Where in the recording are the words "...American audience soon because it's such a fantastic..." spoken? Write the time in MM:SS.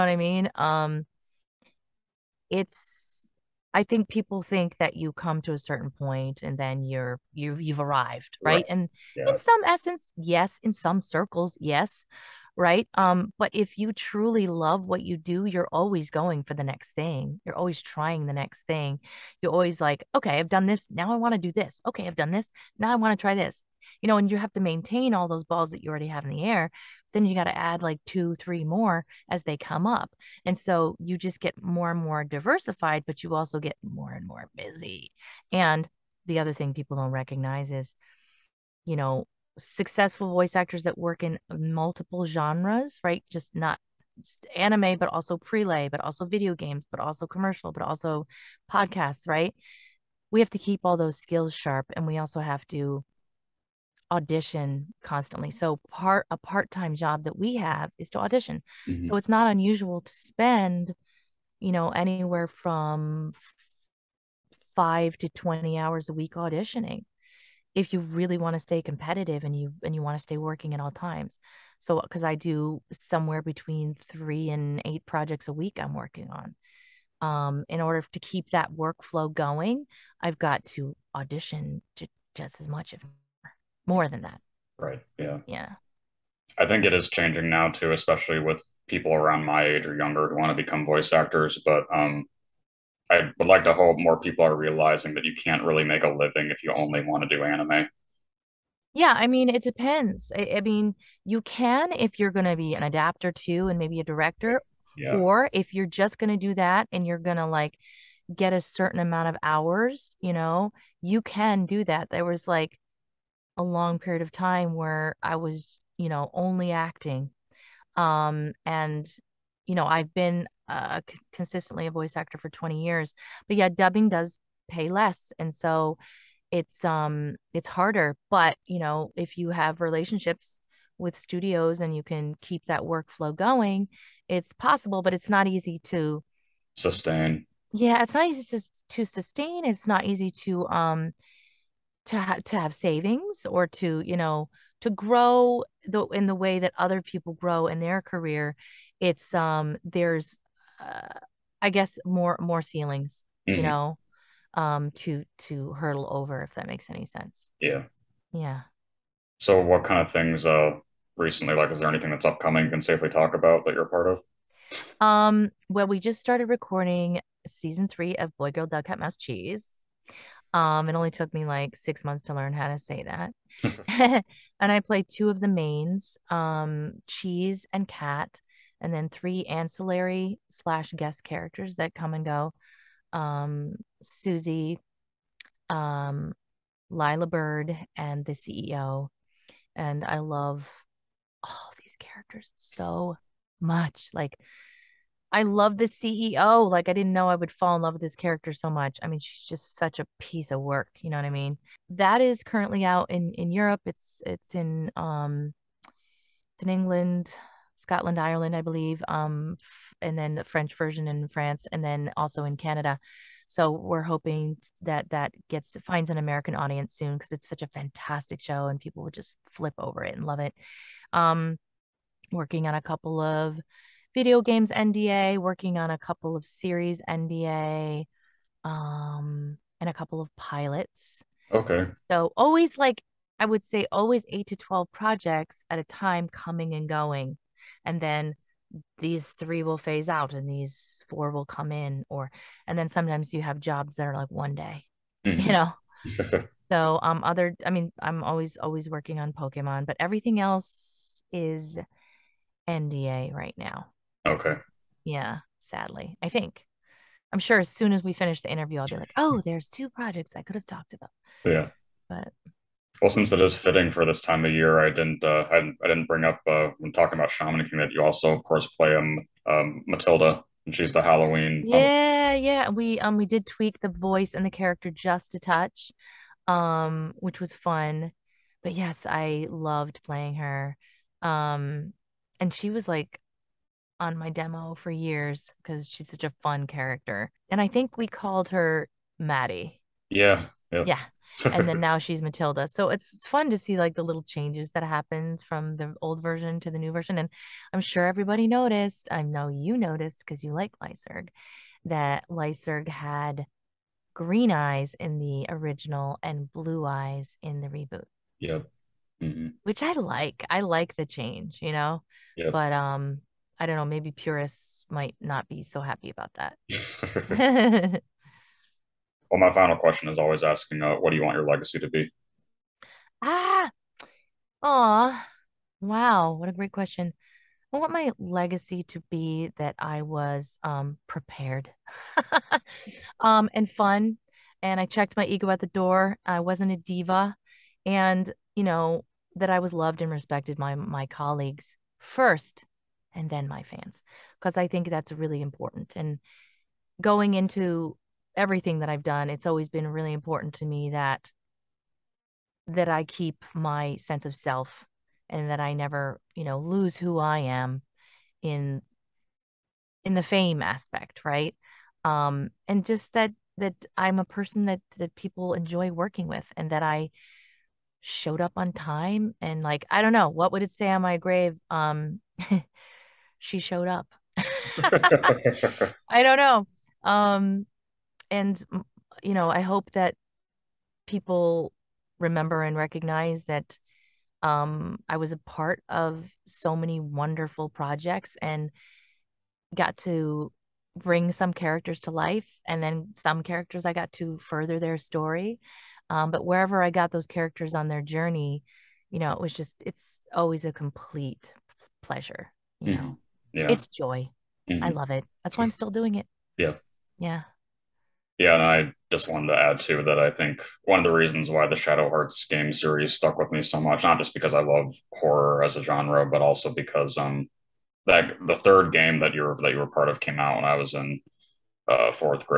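03:36.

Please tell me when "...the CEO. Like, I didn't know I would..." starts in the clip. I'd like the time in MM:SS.
03:15.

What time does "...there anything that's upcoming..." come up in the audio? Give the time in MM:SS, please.
02:41.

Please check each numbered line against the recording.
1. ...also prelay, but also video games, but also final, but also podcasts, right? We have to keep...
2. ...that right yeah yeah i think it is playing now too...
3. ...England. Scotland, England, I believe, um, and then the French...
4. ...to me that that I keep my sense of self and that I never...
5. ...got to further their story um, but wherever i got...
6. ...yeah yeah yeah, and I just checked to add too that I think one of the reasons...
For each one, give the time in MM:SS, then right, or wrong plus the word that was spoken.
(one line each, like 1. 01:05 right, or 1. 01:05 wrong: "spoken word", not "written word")
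1. 00:45 wrong: "commercial", not "final"
2. 01:24 wrong: "changing", not "playing"
3. 03:26 wrong: "Ireland", not "England"
4. 05:50 right
5. 06:33 right
6. 06:46 wrong: "wanted", not "checked".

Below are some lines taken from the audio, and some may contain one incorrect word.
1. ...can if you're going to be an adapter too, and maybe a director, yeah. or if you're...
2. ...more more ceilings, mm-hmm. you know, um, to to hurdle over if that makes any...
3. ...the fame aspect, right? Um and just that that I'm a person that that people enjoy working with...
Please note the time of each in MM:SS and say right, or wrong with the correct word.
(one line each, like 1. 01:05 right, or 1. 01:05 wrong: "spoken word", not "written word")
1. 01:41 right
2. 02:32 right
3. 06:00 right.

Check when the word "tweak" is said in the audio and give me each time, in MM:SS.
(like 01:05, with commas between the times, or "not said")
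04:33.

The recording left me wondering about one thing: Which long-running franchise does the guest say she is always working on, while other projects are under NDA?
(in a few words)
Pokemon.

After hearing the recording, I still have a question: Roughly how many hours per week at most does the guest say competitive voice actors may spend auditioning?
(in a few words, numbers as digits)
20.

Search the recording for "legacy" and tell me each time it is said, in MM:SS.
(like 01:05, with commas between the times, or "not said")
05:21, 05:28.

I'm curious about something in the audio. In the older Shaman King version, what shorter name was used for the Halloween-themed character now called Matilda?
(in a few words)
Maddie.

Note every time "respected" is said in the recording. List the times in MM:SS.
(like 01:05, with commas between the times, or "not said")
05:40.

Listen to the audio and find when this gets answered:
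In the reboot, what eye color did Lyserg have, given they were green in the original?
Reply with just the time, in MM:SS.
05:06.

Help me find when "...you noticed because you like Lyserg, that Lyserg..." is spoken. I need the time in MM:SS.
04:59.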